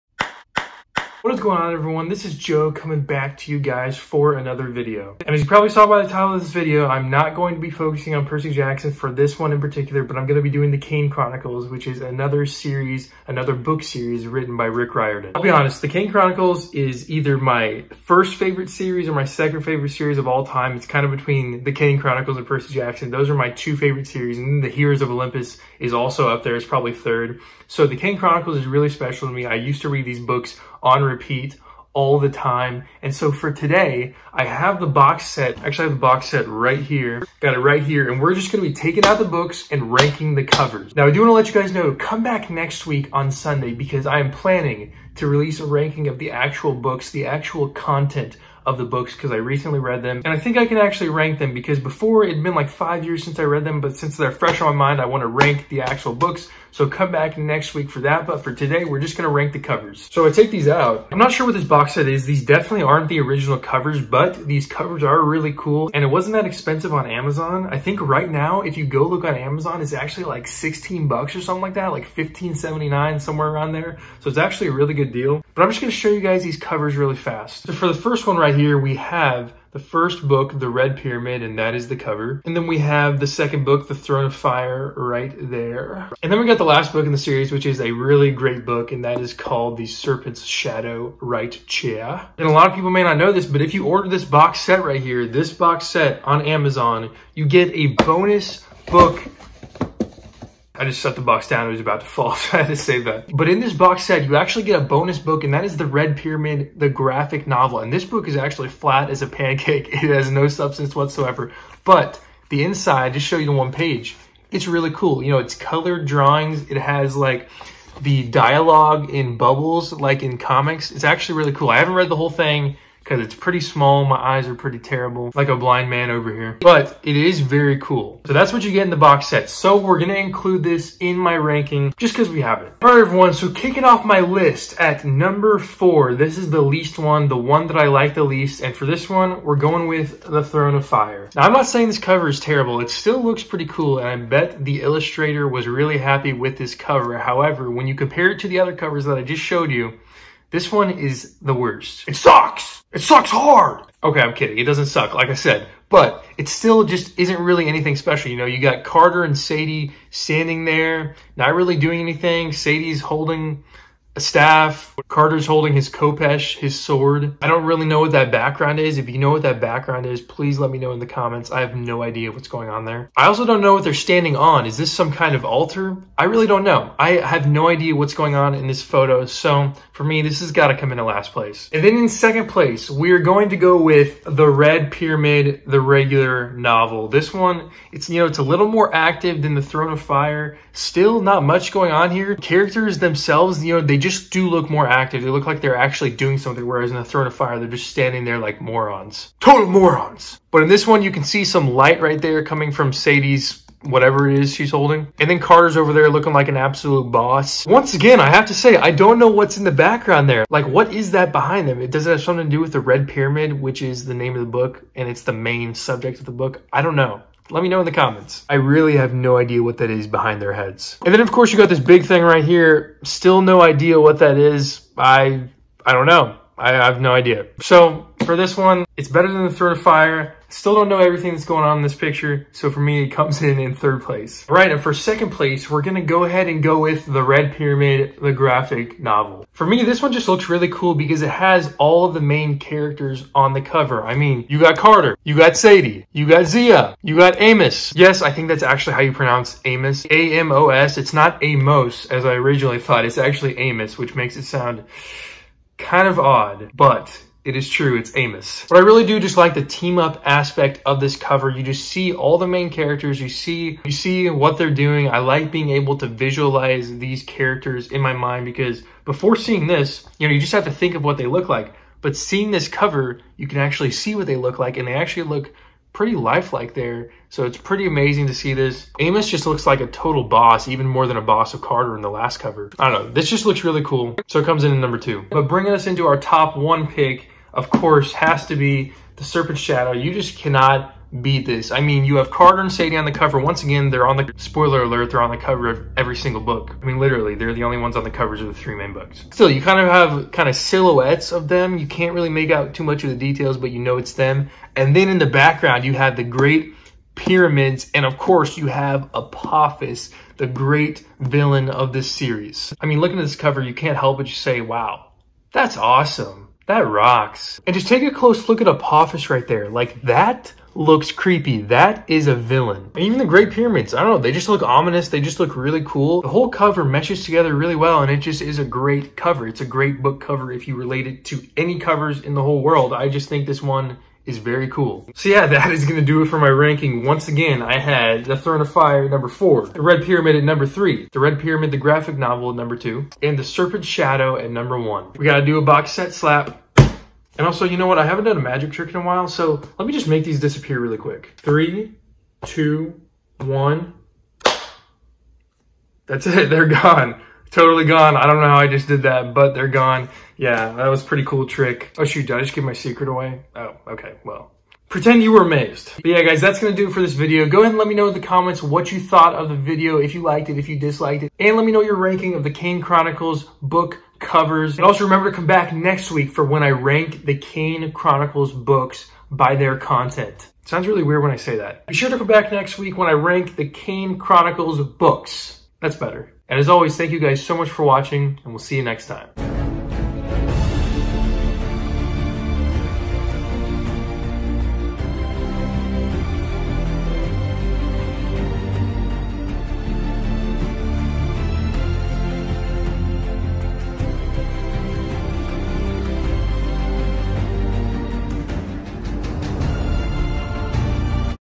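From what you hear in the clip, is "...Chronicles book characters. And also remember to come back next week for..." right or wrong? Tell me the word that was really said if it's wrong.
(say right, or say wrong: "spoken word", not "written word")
wrong: "covers", not "characters".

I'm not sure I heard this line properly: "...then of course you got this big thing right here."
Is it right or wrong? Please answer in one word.
right.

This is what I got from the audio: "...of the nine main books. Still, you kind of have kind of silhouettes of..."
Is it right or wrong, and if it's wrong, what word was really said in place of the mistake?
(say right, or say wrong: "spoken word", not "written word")
wrong: "three", not "nine".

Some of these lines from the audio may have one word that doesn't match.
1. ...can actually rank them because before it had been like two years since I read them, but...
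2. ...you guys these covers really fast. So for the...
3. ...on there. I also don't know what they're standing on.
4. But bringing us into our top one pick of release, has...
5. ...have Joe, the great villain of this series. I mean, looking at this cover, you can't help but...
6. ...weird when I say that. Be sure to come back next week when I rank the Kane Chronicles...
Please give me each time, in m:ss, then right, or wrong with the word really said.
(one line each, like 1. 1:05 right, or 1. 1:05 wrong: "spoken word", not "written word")
1. 0:50 wrong: "five", not "two"
2. 1:16 right
3. 2:52 right
4. 4:45 wrong: "course", not "release"
5. 5:08 wrong: "Apophis", not "Joe"
6. 6:21 right.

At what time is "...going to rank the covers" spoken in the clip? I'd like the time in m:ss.
0:59.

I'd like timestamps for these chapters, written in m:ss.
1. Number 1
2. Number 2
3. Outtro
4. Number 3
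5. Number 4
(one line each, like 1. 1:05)
1. 4:45
2. 3:54
3. 5:35
4. 3:01
5. 2:12.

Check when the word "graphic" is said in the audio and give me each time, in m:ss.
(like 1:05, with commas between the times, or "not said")
1:46, 3:58, 5:41.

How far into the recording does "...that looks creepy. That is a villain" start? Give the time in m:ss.
5:20.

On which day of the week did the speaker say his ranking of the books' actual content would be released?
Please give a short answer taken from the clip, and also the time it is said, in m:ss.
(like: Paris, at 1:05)
Sunday, at 0:43.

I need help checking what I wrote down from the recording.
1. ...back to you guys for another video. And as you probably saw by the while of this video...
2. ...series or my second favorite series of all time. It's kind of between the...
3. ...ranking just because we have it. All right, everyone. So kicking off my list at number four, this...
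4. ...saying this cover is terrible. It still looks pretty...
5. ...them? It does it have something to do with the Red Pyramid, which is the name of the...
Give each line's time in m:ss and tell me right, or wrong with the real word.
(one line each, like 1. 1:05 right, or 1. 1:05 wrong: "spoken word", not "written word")
1. 0:03 wrong: "title", not "while"
2. 0:18 right
3. 2:11 right
4. 2:21 right
5. 3:31 right.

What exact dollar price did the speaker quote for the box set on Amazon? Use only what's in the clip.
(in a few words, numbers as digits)
$15.79.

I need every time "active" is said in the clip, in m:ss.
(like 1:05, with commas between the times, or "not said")
3:08, 3:14.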